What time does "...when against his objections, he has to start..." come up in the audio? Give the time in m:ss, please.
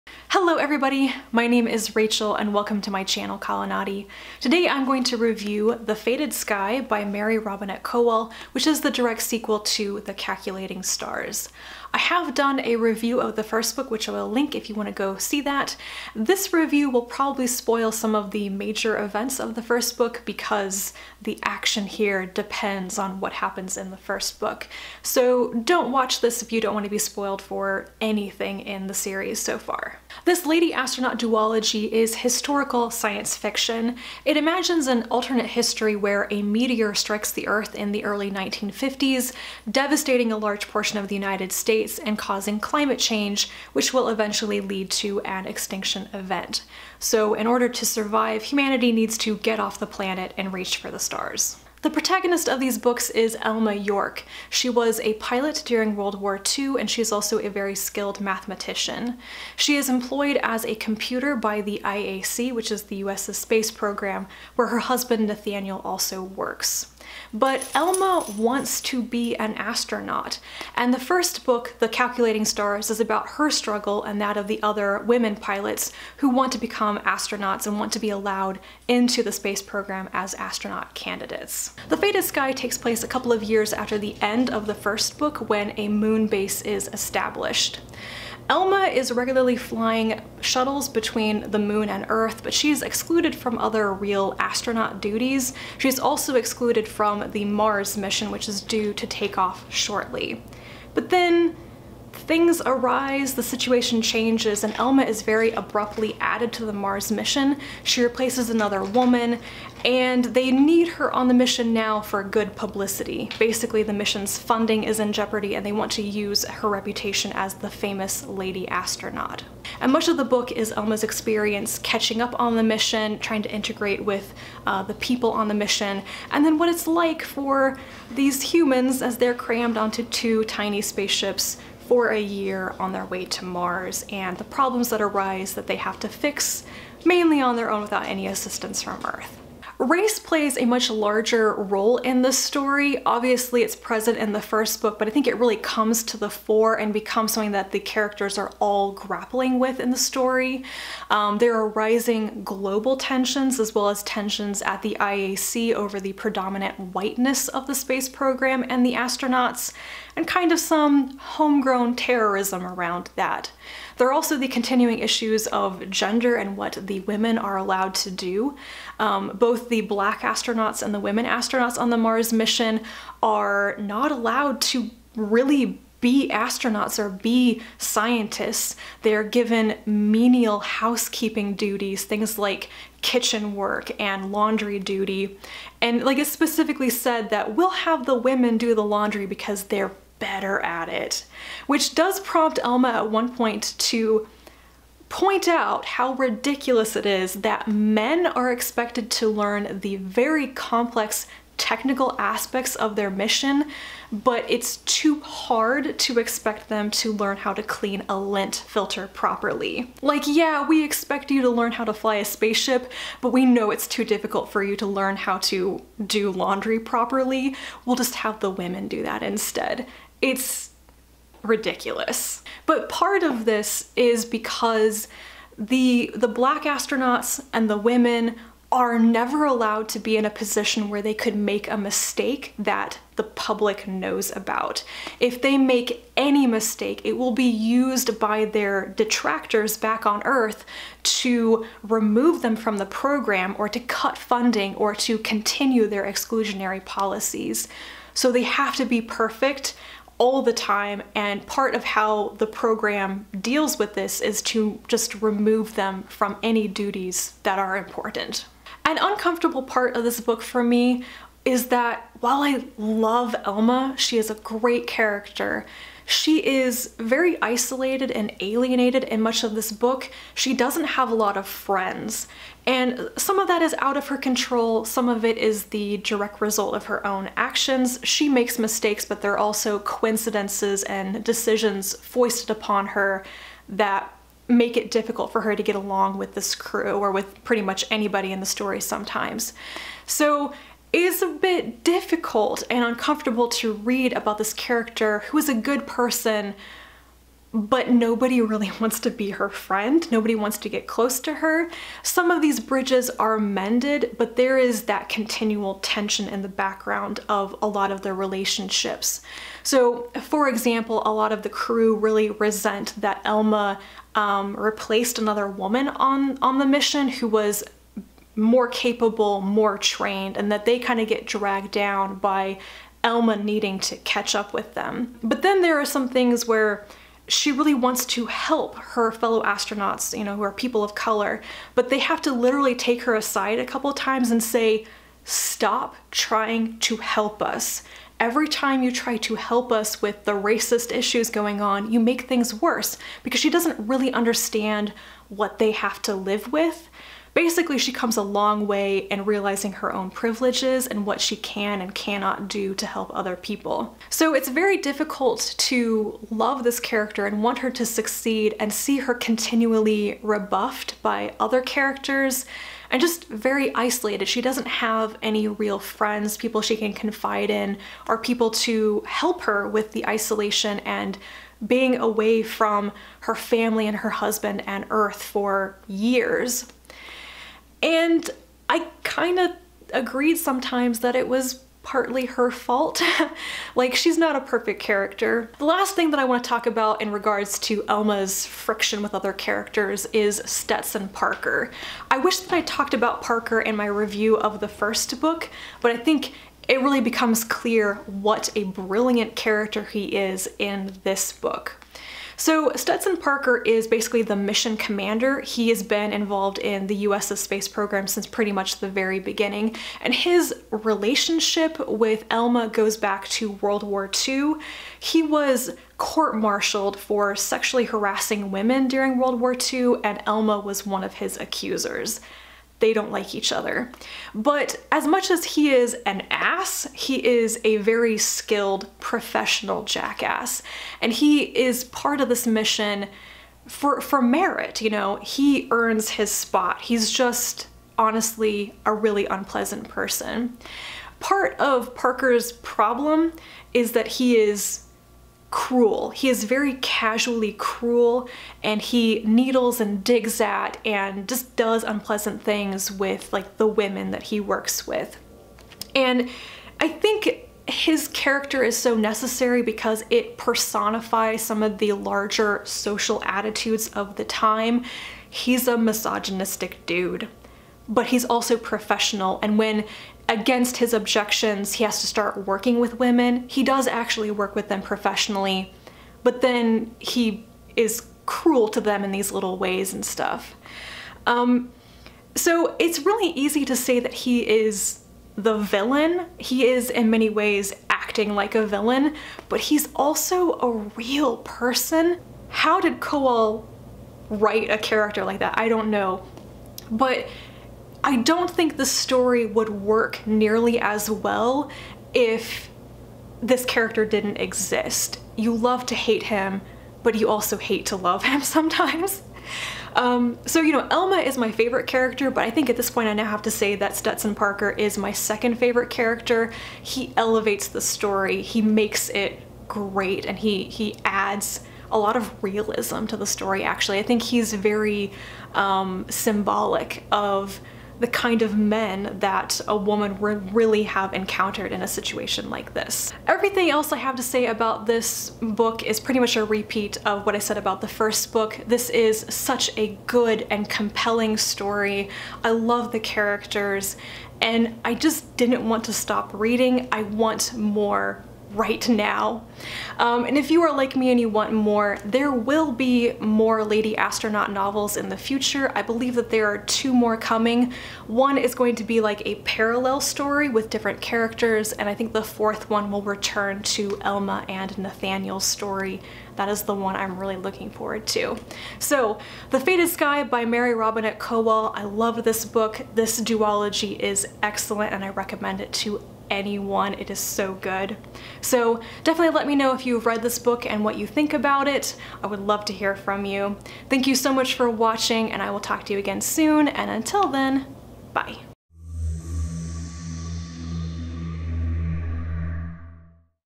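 7:49.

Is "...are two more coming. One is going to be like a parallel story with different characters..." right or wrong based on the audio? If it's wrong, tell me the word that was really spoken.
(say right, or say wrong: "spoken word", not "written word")
right.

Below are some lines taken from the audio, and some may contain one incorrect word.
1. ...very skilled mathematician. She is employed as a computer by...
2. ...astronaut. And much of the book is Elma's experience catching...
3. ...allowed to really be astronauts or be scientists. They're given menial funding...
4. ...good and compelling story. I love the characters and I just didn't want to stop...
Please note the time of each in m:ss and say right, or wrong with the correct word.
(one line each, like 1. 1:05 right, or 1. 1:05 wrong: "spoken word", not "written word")
1. 0:57 right
2. 1:58 right
3. 2:54 wrong: "housekeeping", not "funding"
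4. 9:00 right.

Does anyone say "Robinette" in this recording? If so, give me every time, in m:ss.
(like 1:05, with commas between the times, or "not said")
0:07, 9:30.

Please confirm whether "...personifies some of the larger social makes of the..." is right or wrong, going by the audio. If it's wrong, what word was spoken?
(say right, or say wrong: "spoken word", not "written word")
wrong: "attitudes", not "makes".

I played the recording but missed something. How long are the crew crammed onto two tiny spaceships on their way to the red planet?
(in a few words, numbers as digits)
a year.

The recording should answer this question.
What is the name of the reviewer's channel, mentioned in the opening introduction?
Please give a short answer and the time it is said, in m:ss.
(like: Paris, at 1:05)
Kalanadi, at 0:03.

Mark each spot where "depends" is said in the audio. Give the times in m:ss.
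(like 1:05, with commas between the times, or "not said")
0:22.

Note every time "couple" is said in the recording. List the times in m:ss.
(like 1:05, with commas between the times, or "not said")
1:23, 5:33.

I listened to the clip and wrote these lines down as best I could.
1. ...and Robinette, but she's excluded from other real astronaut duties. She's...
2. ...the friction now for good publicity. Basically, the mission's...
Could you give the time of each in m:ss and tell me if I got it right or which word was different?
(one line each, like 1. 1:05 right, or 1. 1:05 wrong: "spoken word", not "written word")
1. 1:31 wrong: "Earth", not "Robinette"
2. 1:51 wrong: "mission", not "friction".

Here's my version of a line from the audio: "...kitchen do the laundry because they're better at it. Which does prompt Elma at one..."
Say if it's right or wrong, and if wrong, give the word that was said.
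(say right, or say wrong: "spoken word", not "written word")
wrong: "women", not "kitchen".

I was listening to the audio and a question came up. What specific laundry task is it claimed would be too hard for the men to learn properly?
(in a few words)
clean a lint filter.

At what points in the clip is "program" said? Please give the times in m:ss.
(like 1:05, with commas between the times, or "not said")
1:03, 1:19, 2:38, 4:02, 4:12, 6:47.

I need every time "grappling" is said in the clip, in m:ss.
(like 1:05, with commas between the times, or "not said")
2:28.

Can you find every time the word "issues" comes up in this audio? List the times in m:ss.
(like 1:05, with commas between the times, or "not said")
2:44, 5:40.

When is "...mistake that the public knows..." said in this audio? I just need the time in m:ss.
3:51.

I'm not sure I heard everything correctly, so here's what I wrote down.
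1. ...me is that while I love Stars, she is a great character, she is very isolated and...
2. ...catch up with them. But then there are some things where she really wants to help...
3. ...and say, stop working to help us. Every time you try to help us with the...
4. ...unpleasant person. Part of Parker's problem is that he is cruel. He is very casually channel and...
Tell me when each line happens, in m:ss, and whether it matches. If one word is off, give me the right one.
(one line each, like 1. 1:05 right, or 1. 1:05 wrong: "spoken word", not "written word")
1. 4:20 wrong: "Elma", not "Stars"
2. 5:23 right
3. 5:34 wrong: "trying", not "working"
4. 7:19 wrong: "cruel", not "channel".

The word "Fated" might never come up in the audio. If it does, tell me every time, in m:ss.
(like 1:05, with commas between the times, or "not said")
0:05, 1:21, 9:29.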